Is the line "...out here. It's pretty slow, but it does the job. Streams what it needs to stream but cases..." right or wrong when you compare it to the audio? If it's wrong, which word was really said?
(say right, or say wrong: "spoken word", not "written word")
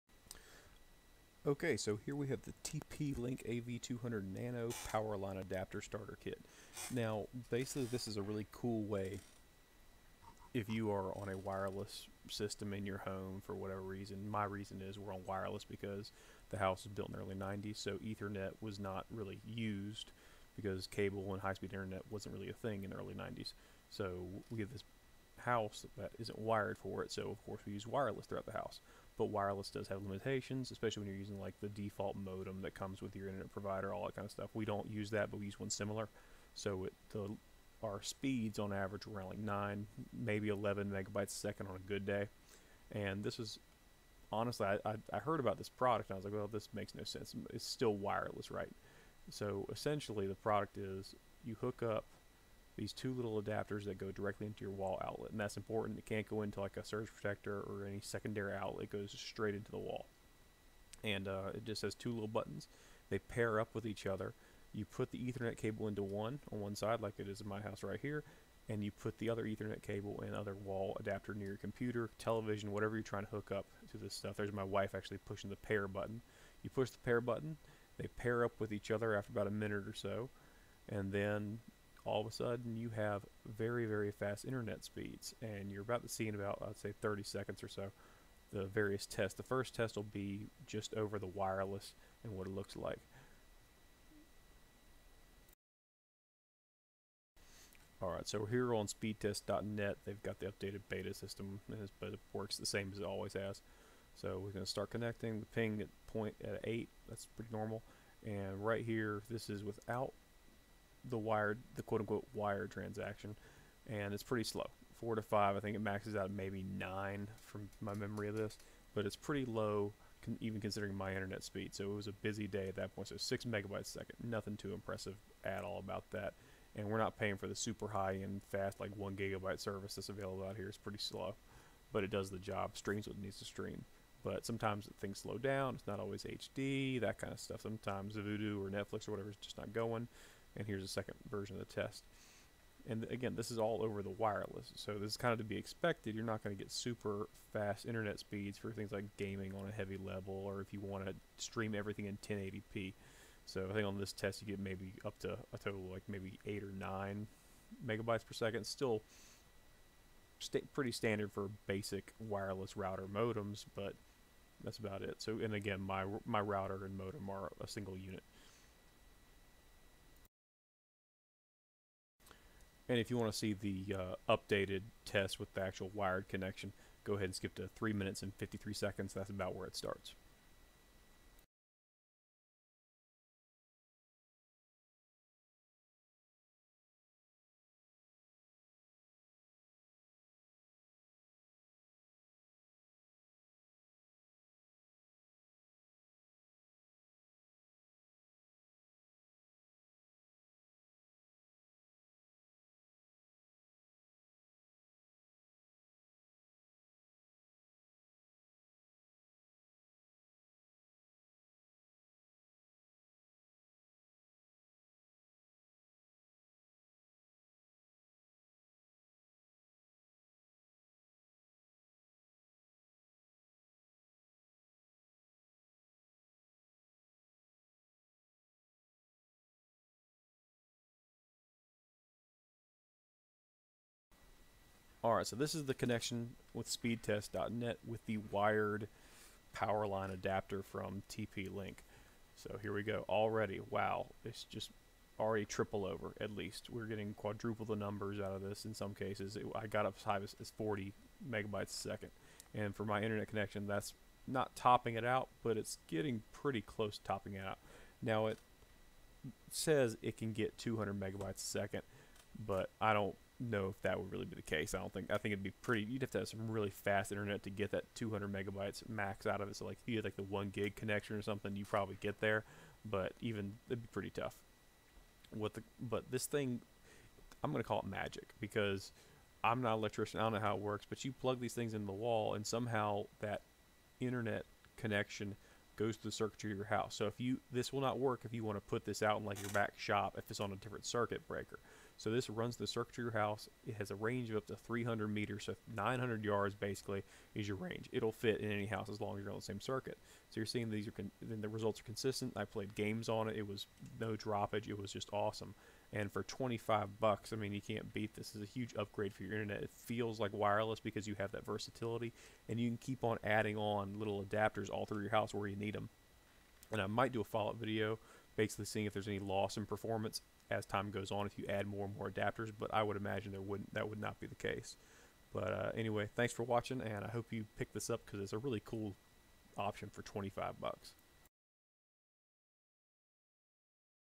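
wrong: "sometimes", not "cases".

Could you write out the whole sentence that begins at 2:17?
Sometimes Vudu or Netflix or whatever is just not going and here's a second version of the test.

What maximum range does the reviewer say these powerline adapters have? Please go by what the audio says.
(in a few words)
300 meters.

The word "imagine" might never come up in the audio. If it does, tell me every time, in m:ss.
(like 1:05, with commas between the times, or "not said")
5:22.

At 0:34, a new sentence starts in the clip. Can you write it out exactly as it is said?
We don't use that, but we use one similar.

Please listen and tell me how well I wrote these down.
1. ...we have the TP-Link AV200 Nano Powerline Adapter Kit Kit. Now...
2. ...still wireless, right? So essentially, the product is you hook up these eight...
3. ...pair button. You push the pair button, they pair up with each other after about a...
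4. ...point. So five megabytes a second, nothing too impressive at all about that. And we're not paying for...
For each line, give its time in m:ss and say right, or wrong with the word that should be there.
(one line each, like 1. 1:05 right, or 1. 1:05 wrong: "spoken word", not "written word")
1. 0:02 wrong: "Starter", not "Kit"
2. 0:47 wrong: "two", not "eight"
3. 1:15 right
4. 2:02 wrong: "six", not "five".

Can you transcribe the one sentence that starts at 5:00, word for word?
So you're seeing these are then the results are consistent.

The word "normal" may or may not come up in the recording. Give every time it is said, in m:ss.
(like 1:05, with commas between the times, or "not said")
1:47.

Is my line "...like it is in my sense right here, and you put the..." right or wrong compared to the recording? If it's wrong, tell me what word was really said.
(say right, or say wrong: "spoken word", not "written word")
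wrong: "house", not "sense".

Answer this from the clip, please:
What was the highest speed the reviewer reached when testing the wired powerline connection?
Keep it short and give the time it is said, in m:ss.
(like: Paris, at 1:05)
40 megabytes a second, at 4:10.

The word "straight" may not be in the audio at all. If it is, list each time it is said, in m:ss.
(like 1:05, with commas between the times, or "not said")
0:59.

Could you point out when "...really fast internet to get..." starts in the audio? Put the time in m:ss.
4:26.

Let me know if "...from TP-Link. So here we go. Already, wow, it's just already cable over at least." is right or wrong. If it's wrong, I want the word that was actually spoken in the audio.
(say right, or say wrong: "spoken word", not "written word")
wrong: "triple", not "cable".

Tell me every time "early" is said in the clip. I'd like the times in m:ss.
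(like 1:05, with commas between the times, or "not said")
0:17, 0:22.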